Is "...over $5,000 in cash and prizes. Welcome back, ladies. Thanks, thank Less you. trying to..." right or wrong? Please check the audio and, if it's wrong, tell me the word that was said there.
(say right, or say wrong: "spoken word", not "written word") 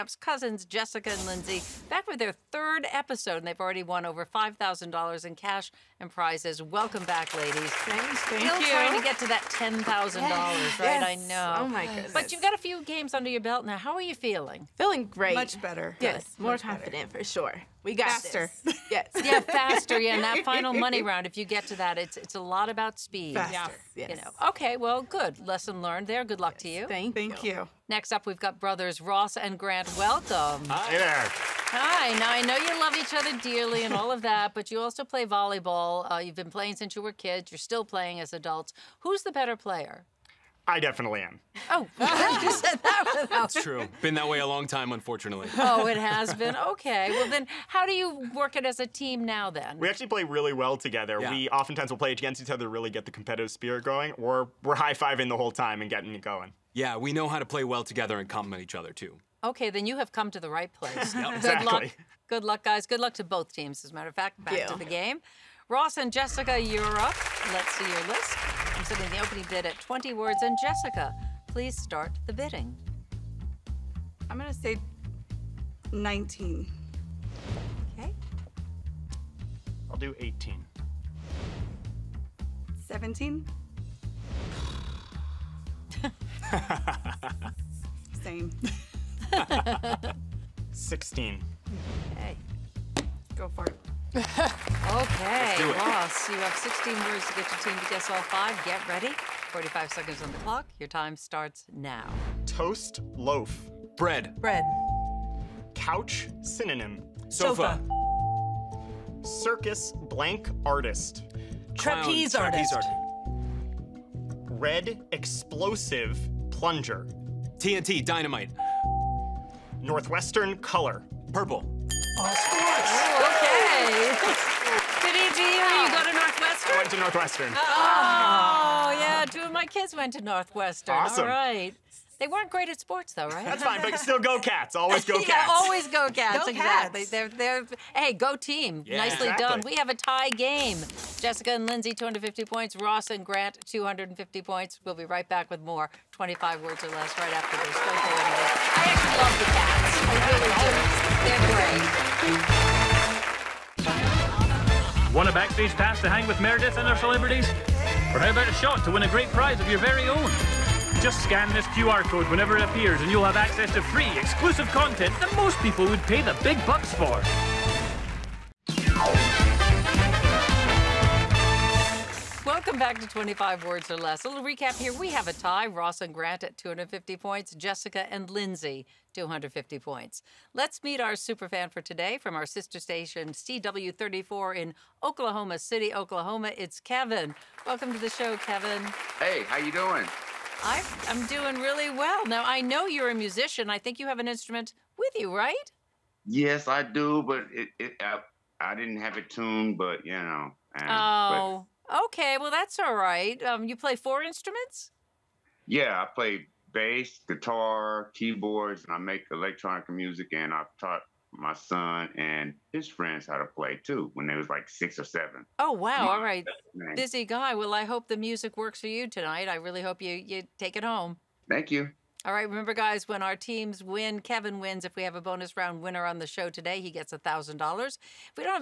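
wrong: "Still", not "Less".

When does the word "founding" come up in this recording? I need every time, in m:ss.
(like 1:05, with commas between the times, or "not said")
not said.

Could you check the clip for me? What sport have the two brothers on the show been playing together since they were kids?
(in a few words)
volleyball.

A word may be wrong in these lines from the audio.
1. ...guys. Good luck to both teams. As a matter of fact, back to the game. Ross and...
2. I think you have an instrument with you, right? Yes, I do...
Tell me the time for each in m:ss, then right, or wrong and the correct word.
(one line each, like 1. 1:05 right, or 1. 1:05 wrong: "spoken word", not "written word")
1. 1:02 right
2. 3:13 right.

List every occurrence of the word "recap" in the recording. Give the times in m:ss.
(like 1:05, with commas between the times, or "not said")
2:54.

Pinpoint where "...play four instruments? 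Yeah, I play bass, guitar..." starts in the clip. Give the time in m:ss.
3:23.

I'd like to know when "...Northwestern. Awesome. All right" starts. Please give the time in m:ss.
2:10.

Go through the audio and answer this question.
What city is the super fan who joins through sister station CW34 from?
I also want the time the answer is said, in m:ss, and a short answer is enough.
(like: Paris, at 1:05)
Oklahoma City, at 3:05.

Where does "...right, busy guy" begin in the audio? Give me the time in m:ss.
3:36.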